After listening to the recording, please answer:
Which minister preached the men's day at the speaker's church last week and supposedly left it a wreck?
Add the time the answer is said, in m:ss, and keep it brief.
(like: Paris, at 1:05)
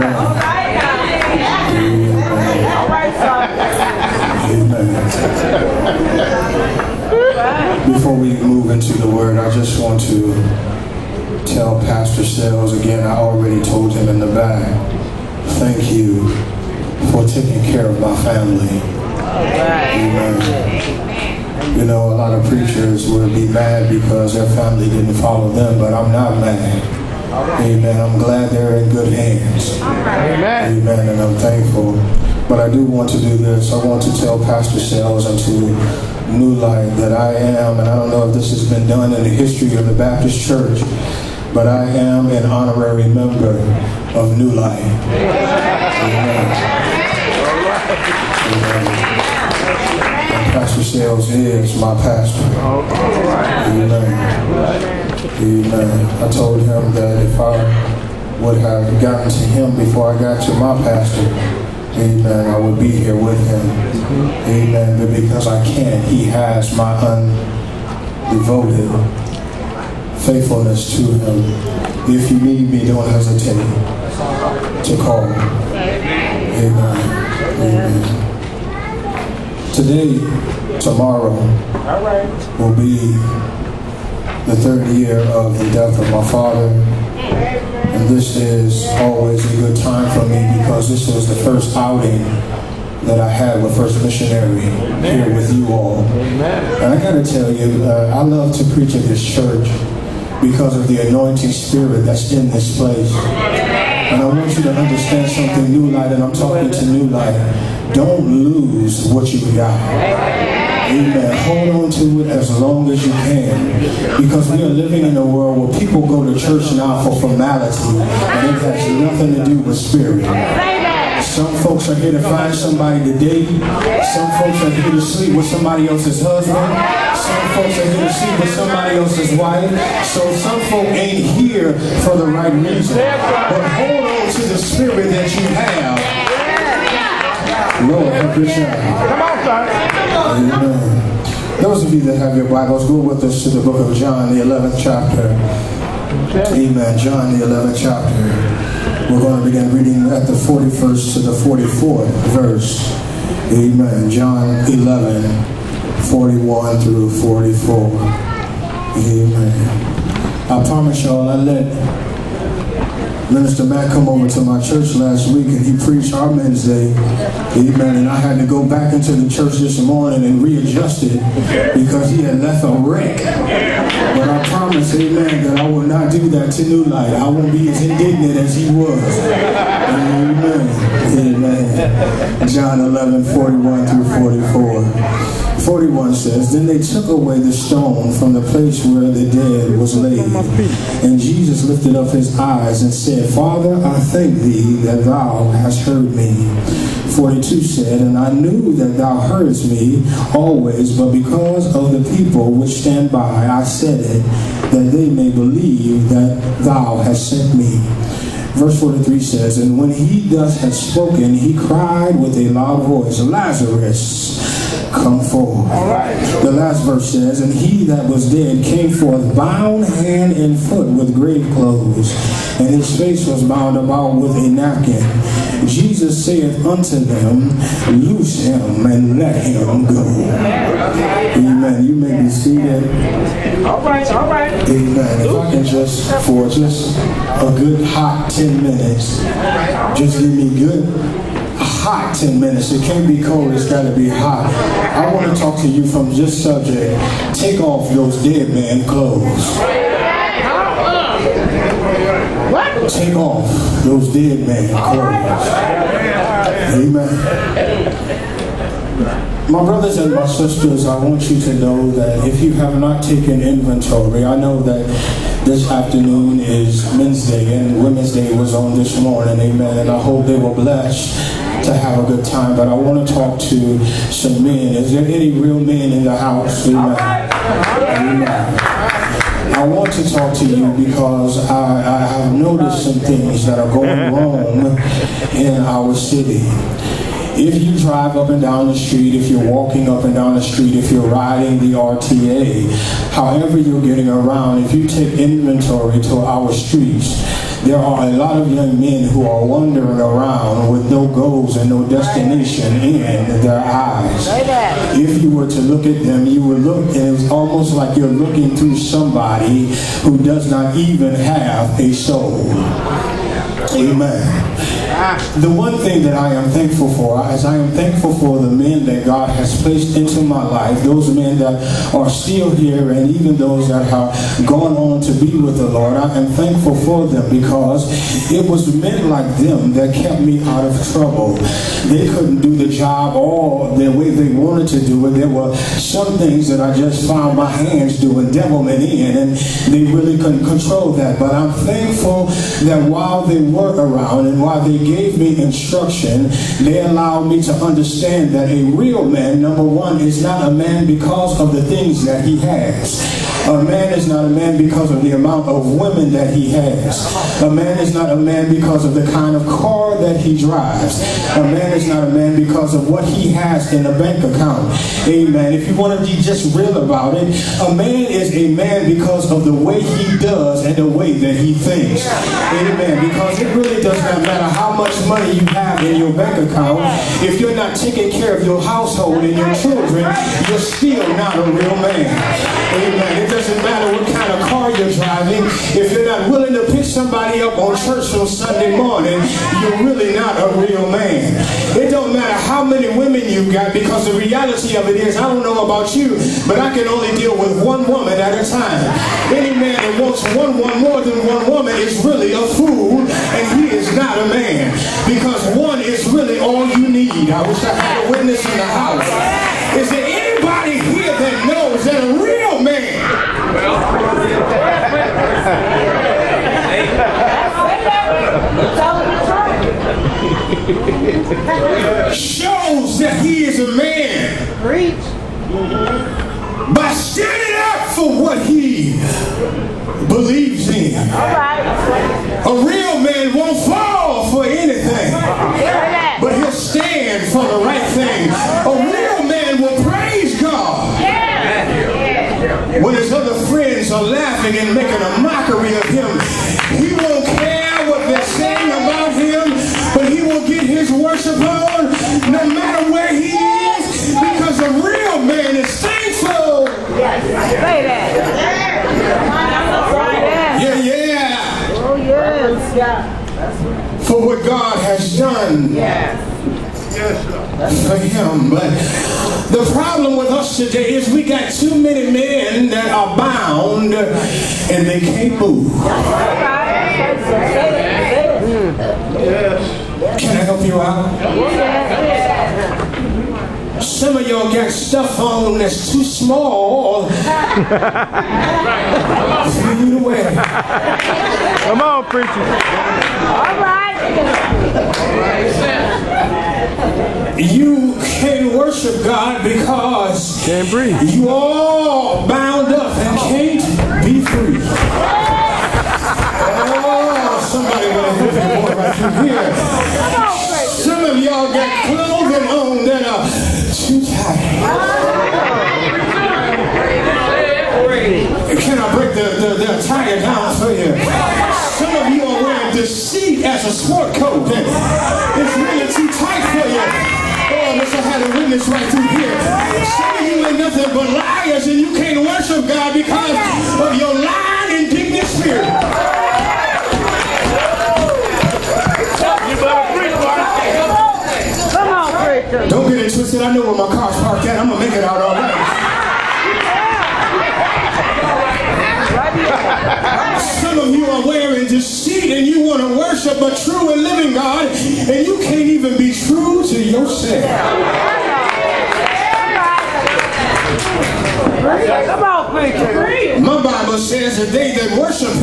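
Minister Matt, at 2:43.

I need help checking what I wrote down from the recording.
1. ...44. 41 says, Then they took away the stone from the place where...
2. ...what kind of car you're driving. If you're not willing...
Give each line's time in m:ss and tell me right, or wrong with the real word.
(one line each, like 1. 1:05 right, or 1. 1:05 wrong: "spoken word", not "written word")
1. 3:05 right
2. 6:23 right.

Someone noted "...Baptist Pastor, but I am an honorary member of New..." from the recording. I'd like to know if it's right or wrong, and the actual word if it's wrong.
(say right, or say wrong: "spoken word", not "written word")
wrong: "Church", not "Pastor".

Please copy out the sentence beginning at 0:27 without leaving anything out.
I'm glad they're in good hands.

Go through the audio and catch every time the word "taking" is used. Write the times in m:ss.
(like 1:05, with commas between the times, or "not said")
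0:17, 6:17.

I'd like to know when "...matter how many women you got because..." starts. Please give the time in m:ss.
6:32.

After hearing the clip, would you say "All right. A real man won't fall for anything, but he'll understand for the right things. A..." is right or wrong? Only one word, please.
wrong.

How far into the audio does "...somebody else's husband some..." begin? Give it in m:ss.
2:05.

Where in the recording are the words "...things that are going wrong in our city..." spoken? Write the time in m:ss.
4:42.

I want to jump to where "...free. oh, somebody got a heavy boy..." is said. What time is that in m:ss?
8:24.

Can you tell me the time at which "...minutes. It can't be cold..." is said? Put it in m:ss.
4:02.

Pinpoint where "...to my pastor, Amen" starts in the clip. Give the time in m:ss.
1:00.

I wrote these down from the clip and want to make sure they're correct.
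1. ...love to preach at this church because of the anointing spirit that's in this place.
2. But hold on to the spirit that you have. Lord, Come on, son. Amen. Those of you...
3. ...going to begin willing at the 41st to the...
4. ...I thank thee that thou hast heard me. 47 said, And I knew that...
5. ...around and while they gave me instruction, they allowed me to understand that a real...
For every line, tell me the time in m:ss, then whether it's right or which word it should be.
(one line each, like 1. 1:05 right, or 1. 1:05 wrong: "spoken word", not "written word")
1. 1:38 right
2. 2:12 right
3. 2:29 wrong: "reading", not "willing"
4. 3:13 wrong: "42", not "47"
5. 5:43 right.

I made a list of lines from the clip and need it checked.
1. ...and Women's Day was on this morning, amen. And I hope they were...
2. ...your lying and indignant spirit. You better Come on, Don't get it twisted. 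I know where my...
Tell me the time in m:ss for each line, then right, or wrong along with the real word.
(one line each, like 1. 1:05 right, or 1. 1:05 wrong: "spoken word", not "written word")
1. 4:27 right
2. 8:53 right.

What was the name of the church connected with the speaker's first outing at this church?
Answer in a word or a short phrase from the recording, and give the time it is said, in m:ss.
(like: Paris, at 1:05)
First Missionary, at 1:33.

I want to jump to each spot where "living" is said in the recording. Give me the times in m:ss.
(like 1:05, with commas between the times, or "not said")
1:54, 9:14.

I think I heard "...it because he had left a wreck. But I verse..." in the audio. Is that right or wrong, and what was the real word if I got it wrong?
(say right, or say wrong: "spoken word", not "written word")
wrong: "promise", not "verse".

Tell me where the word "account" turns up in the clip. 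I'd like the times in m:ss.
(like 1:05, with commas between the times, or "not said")
6:04, 6:16.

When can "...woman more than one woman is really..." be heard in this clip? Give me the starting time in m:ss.
6:40.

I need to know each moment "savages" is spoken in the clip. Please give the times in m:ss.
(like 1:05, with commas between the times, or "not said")
not said.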